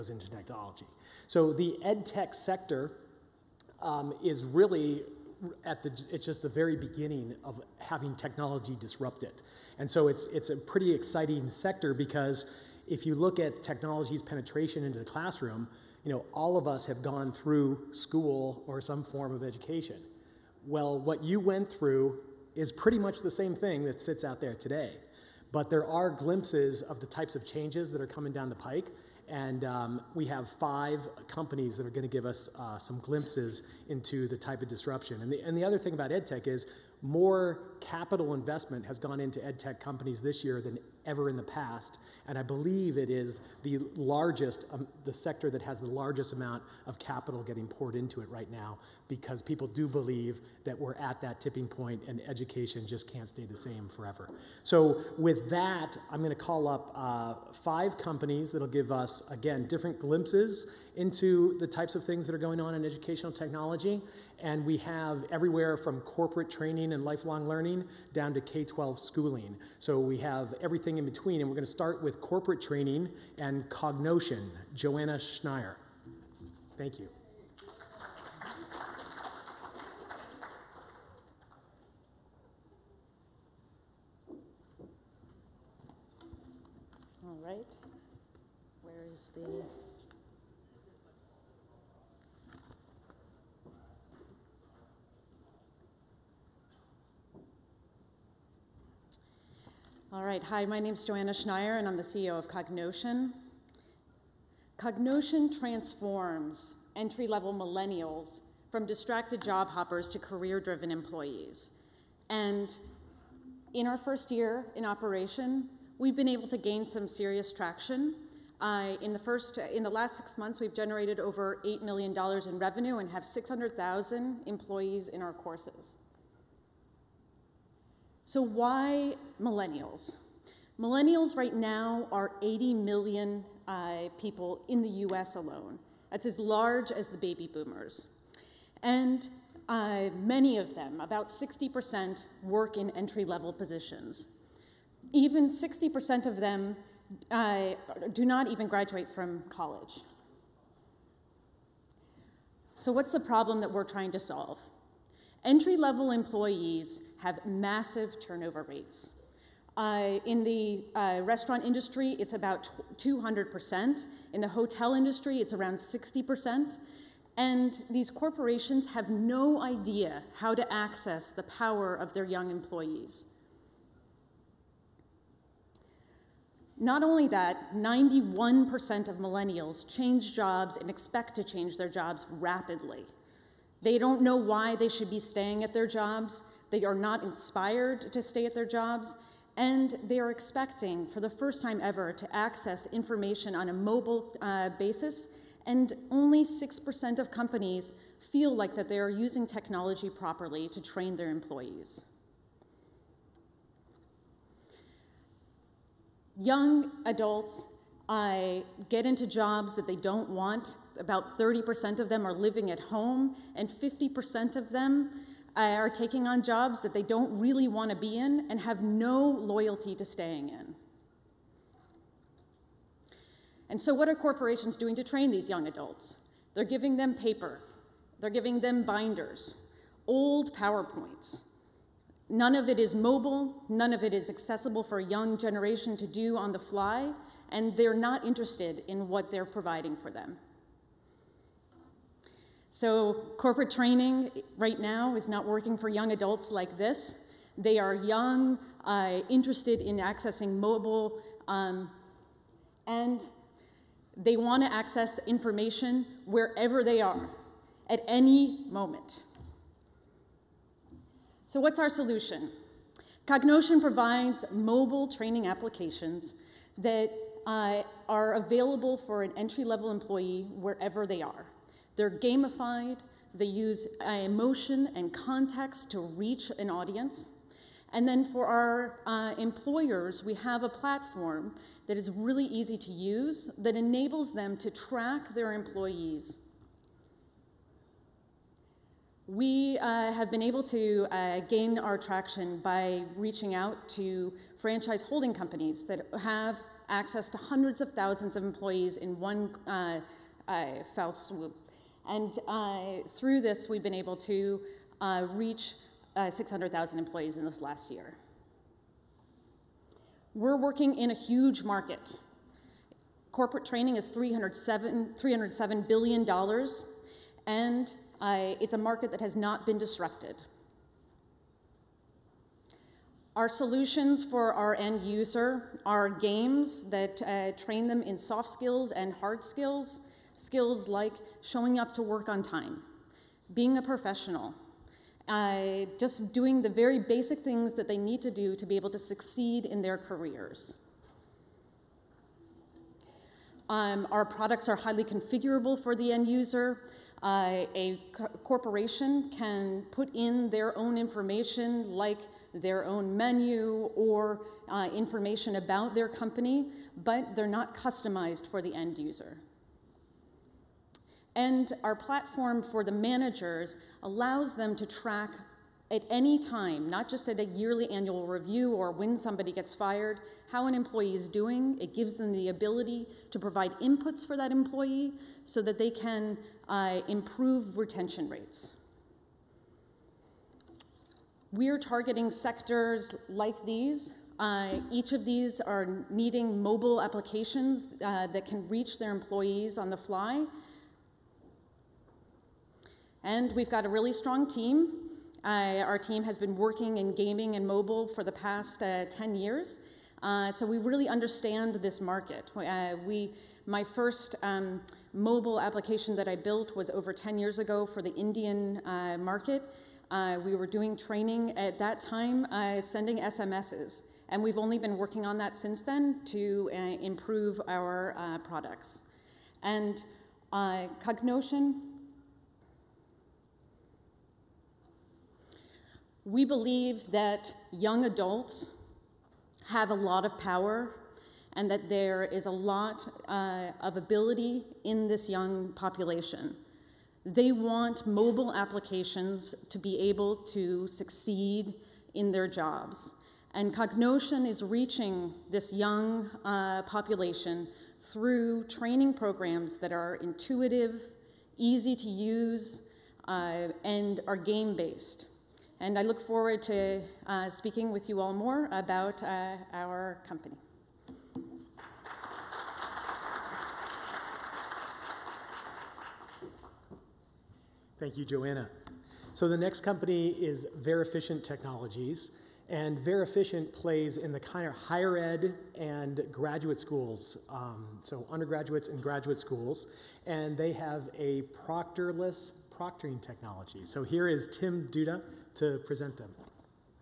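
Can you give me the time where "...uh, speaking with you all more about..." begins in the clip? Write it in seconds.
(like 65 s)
457 s.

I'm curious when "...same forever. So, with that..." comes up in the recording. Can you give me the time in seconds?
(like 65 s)
53 s.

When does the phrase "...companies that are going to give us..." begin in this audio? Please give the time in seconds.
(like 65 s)
31 s.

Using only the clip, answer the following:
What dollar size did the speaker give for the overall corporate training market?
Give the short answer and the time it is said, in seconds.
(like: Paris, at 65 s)
$307 billion, at 315 s.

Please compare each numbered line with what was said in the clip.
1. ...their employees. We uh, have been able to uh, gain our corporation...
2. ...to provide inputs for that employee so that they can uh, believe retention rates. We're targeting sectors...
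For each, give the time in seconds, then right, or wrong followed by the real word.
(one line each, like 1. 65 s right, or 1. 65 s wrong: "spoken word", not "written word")
1. 285 s wrong: "traction", not "corporation"
2. 373 s wrong: "improve", not "believe".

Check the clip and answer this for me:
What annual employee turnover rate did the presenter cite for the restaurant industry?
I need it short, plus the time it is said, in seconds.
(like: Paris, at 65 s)
200%, at 162 s.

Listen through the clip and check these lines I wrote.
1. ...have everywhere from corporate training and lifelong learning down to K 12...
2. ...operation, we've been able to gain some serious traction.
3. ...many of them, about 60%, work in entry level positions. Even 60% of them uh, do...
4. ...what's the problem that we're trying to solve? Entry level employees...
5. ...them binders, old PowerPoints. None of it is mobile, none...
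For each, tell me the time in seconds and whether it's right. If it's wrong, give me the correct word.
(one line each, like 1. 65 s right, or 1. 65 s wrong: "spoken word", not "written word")
1. 64 s right
2. 114 s right
3. 140 s right
4. 152 s right
5. 228 s right.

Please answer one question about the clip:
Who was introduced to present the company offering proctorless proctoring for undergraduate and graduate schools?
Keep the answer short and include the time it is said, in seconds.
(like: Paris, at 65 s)
Tim Dutta, at 484 s.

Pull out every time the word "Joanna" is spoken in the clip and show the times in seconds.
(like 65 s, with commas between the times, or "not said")
74 s, 101 s, 468 s.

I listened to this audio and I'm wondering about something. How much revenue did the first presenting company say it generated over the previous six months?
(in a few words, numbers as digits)
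over $8 million.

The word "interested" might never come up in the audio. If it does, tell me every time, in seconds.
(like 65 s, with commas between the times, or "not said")
238 s, 249 s.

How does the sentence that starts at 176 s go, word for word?
Not only that, 91% of millennials change jobs and expect to change their jobs rapidly.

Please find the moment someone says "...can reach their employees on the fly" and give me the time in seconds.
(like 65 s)
388 s.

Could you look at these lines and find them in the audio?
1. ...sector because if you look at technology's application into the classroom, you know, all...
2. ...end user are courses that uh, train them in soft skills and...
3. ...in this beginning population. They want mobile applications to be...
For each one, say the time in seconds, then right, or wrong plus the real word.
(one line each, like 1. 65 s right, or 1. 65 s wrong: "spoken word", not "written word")
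1. 11 s wrong: "penetration", not "application"
2. 324 s wrong: "games", not "courses"
3. 434 s wrong: "young", not "beginning".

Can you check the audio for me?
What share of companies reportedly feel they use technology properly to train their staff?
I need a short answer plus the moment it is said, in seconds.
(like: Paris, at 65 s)
6%, at 196 s.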